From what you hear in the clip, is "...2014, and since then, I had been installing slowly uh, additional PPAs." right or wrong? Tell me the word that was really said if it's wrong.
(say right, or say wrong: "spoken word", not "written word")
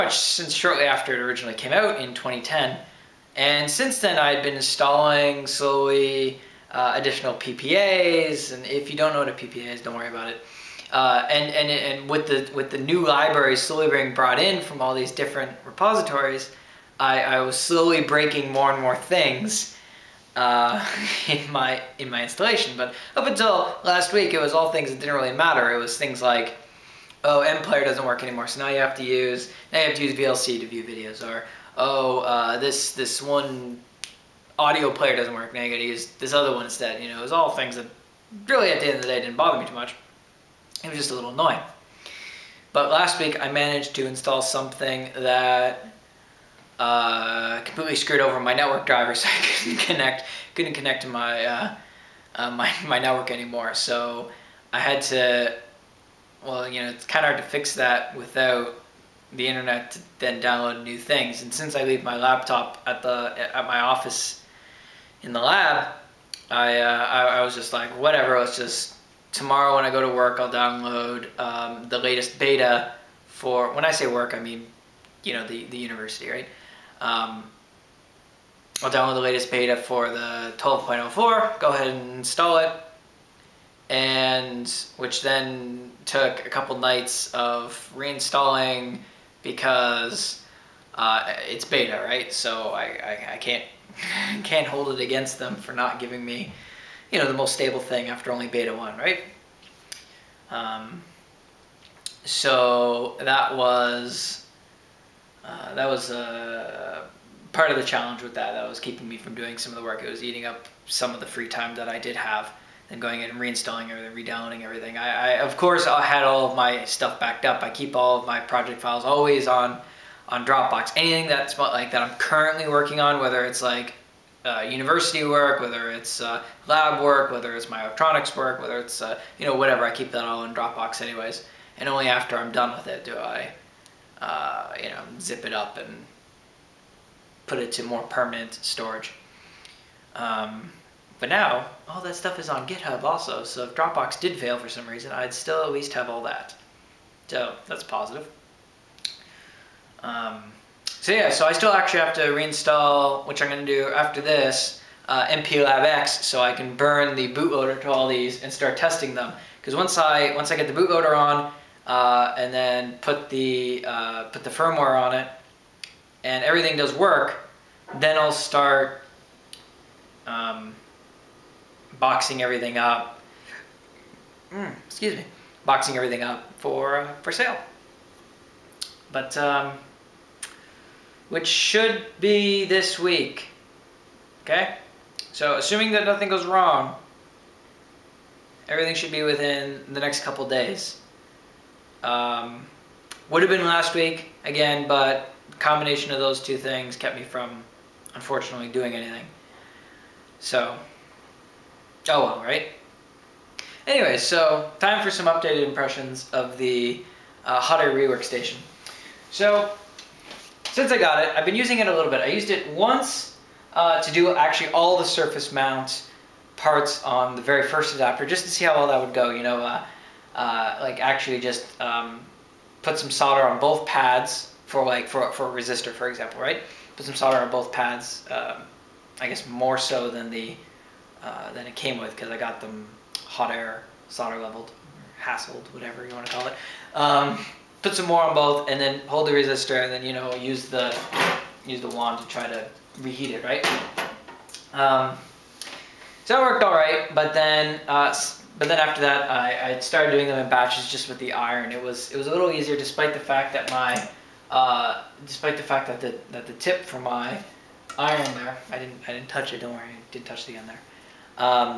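wrong: "2010", not "2014".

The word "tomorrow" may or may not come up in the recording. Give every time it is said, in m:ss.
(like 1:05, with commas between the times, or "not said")
1:09.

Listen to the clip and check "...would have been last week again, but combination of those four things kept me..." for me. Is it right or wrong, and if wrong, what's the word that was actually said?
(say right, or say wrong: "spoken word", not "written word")
wrong: "two", not "four".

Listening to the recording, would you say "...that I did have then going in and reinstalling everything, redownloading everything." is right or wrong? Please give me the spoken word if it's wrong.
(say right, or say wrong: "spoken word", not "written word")
right.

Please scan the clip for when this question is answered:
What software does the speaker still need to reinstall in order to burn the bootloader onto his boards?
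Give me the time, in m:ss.
2:35.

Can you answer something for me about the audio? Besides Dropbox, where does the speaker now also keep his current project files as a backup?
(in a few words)
GitHub.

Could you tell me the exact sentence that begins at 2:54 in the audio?
Mm, excuse me, boxing everything up for uh, for sale.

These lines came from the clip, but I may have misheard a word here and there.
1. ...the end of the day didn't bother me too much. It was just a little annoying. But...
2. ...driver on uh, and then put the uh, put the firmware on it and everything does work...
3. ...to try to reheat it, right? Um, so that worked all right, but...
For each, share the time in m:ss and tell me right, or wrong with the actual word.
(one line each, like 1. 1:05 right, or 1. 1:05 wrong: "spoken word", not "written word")
1. 0:38 right
2. 2:40 wrong: "bootloader", not "driver"
3. 4:02 right.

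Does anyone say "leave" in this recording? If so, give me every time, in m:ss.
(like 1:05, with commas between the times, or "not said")
1:01.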